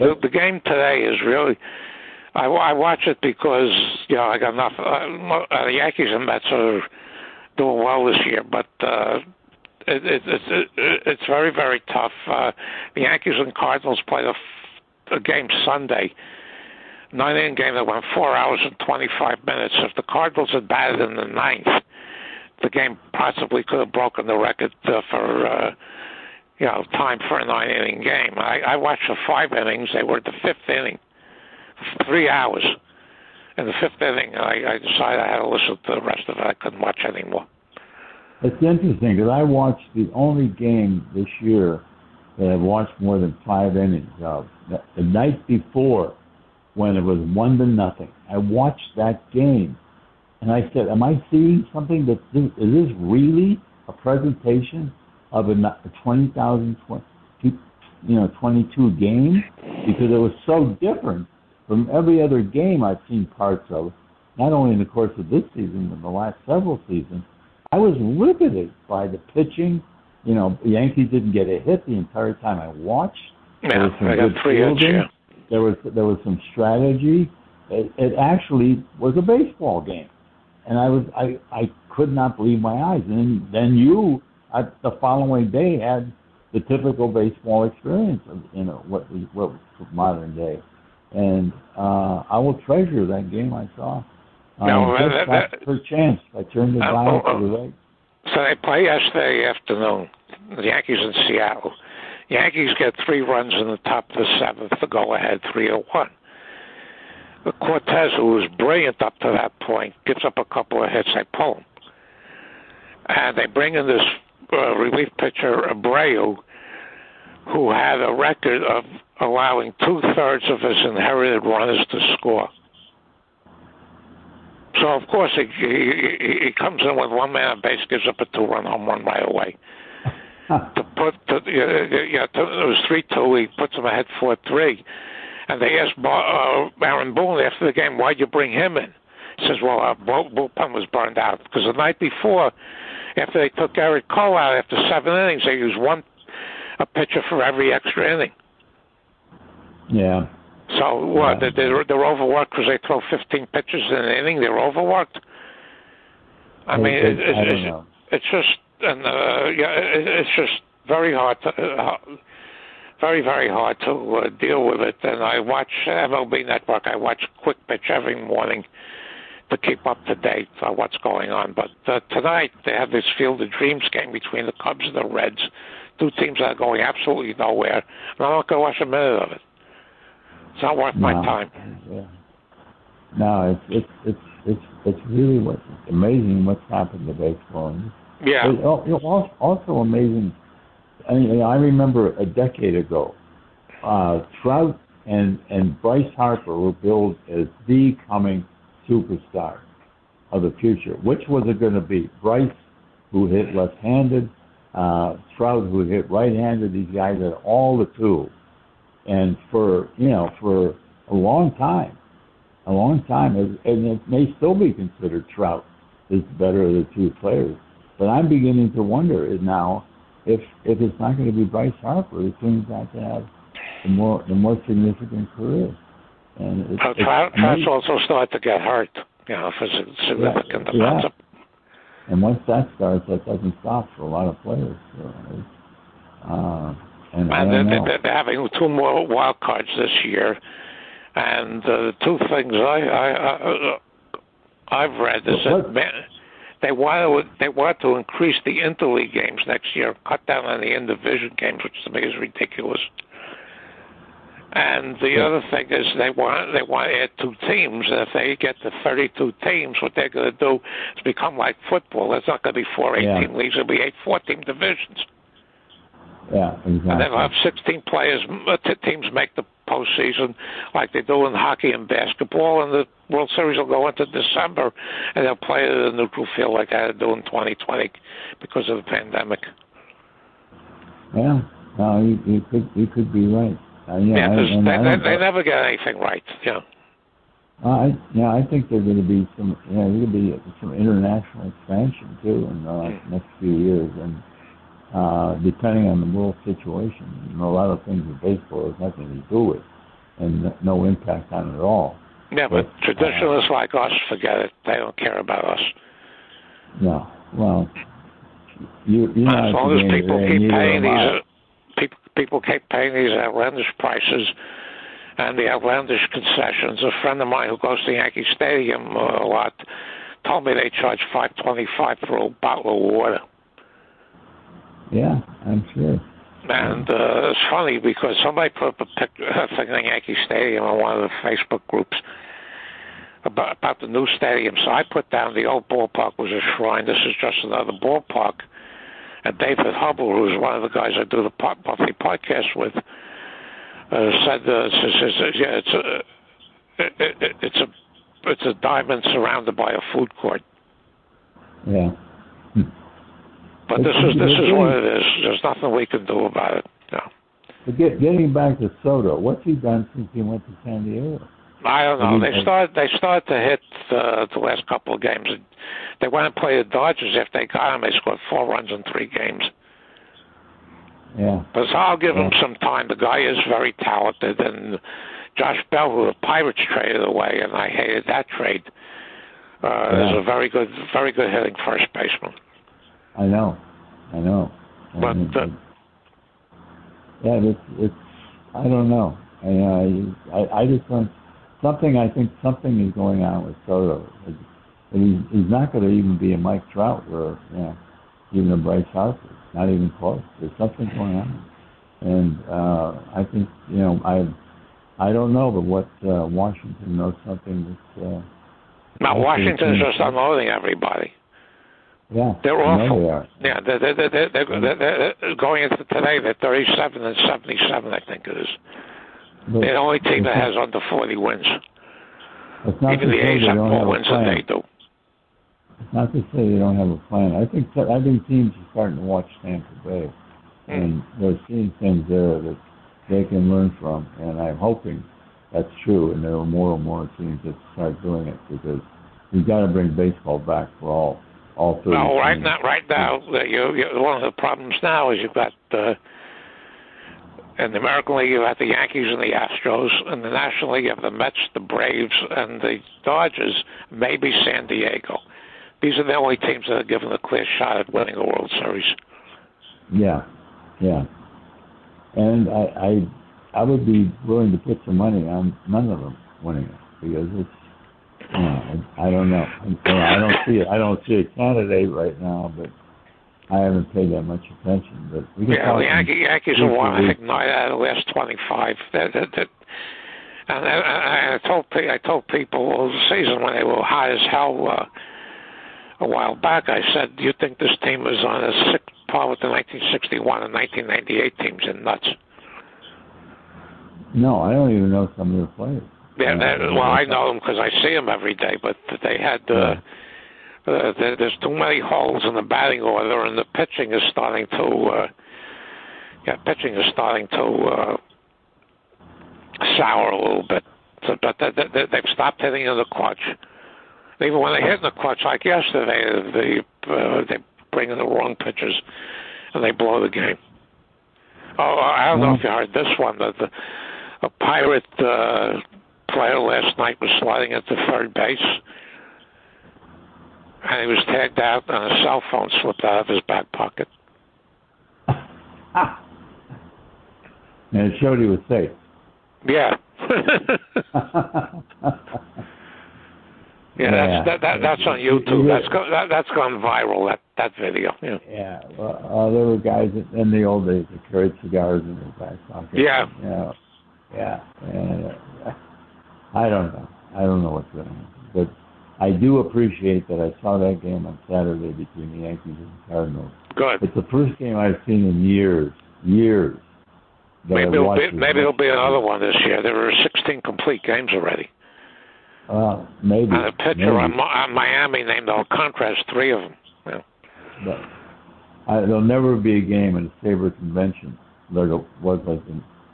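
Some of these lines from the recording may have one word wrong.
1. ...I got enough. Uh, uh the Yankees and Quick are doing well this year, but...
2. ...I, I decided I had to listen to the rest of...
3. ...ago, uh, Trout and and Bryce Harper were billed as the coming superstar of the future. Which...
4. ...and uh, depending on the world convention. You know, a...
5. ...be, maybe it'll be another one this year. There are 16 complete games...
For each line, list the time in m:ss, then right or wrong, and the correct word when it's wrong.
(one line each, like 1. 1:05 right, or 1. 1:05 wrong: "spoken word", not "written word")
1. 0:04 wrong: "Mets", not "Quick"
2. 0:34 right
3. 3:12 right
4. 4:54 wrong: "situation", not "convention"
5. 9:27 right.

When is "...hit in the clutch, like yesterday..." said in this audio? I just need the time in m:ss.
8:34.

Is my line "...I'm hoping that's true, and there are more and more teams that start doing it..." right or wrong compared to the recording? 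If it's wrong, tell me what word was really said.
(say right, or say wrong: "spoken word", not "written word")
right.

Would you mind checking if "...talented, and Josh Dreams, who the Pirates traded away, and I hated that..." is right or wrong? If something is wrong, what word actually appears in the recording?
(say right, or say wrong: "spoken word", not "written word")
wrong: "Bell", not "Dreams".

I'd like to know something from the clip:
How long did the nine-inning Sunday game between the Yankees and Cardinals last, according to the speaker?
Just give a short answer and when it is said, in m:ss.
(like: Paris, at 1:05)
4 hours 25 minutes, at 0:18.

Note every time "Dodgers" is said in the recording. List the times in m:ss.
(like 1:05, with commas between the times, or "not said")
6:06, 7:33.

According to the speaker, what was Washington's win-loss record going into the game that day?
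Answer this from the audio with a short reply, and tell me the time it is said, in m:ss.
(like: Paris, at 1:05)
37-77, at 6:56.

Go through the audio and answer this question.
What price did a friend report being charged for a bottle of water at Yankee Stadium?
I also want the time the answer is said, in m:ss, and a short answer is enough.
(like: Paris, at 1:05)
5.25, at 5:21.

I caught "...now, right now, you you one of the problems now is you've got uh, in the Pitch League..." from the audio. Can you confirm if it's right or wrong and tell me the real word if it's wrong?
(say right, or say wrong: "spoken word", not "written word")
wrong: "American", not "Pitch".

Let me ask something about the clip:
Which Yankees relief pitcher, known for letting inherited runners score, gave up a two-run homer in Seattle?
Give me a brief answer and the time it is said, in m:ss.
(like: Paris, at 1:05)
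Abreu, at 1:55.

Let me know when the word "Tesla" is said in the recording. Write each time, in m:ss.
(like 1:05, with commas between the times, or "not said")
not said.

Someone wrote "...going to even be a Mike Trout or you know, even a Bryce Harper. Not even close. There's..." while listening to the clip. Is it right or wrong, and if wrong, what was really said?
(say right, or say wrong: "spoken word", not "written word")
right.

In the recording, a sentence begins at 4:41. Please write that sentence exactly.
Yeah, no, you, you could you could be right.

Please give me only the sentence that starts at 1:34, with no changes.
Um, no, that, that, Per chance I turned the uh, dial oh, to the oh.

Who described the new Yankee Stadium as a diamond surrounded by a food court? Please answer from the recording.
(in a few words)
David Hubble.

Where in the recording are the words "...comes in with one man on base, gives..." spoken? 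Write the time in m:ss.
2:06.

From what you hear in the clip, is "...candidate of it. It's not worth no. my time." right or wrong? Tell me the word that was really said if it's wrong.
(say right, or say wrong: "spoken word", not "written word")
wrong: "minute", not "candidate".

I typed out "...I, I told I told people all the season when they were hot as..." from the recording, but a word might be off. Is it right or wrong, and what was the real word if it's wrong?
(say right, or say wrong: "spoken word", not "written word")
right.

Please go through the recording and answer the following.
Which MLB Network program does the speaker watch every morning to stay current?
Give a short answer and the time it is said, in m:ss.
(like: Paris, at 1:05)
Quick Pitch, at 2:47.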